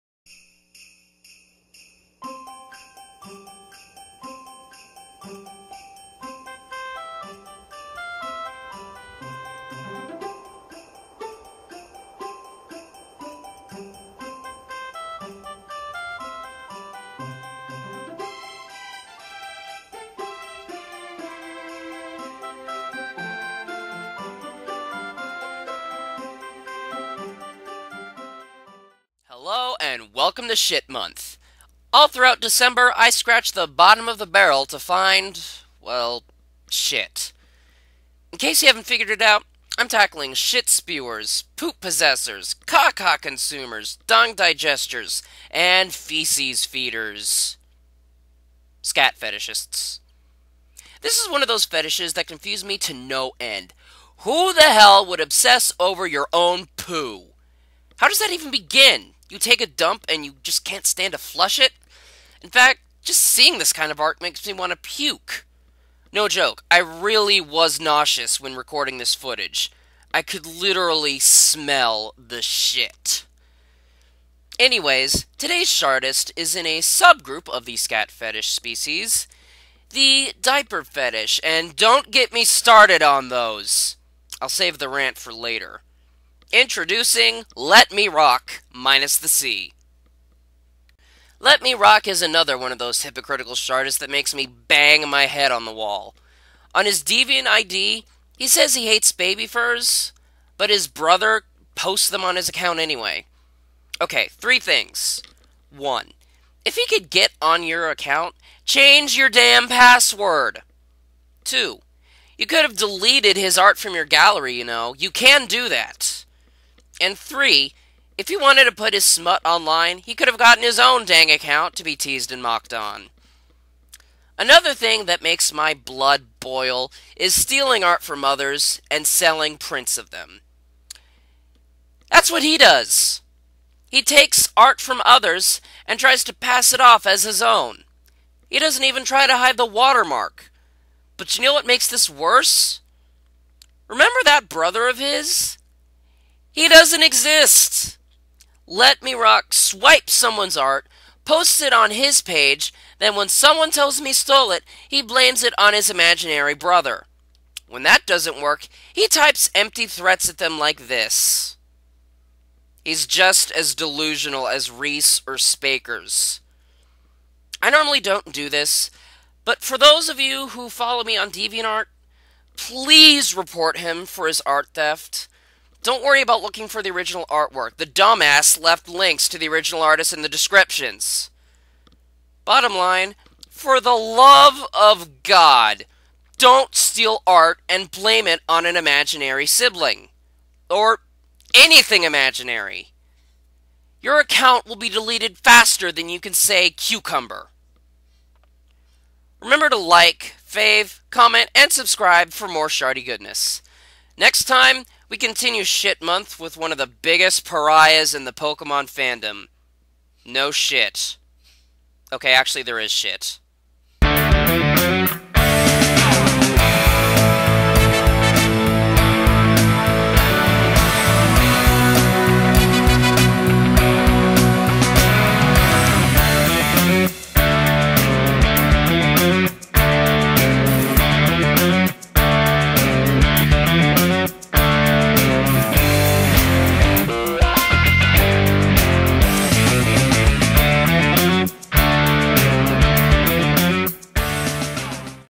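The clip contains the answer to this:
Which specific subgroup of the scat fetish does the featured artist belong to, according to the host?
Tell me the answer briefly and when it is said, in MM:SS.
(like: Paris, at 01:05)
diaper fetish, at 01:19.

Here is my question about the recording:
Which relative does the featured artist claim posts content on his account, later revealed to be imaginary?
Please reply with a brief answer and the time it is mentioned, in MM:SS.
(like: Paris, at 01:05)
his brother, at 01:40.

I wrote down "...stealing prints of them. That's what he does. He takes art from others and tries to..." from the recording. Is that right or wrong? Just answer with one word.
wrong.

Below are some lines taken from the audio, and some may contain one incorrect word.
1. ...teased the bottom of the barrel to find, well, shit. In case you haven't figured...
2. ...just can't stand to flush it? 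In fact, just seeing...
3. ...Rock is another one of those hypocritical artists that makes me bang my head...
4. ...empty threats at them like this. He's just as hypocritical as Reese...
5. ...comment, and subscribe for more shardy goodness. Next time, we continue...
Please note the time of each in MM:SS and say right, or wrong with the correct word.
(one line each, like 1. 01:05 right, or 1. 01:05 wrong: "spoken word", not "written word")
1. 00:33 wrong: "scratched", not "teased"
2. 01:00 right
3. 01:31 right
4. 02:39 wrong: "delusional", not "hypocritical"
5. 03:21 right.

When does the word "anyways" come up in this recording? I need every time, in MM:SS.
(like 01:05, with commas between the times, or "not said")
01:14, 01:42.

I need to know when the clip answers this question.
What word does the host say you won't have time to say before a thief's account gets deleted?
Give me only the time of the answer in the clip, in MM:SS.
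03:16.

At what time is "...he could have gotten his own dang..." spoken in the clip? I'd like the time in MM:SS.
01:59.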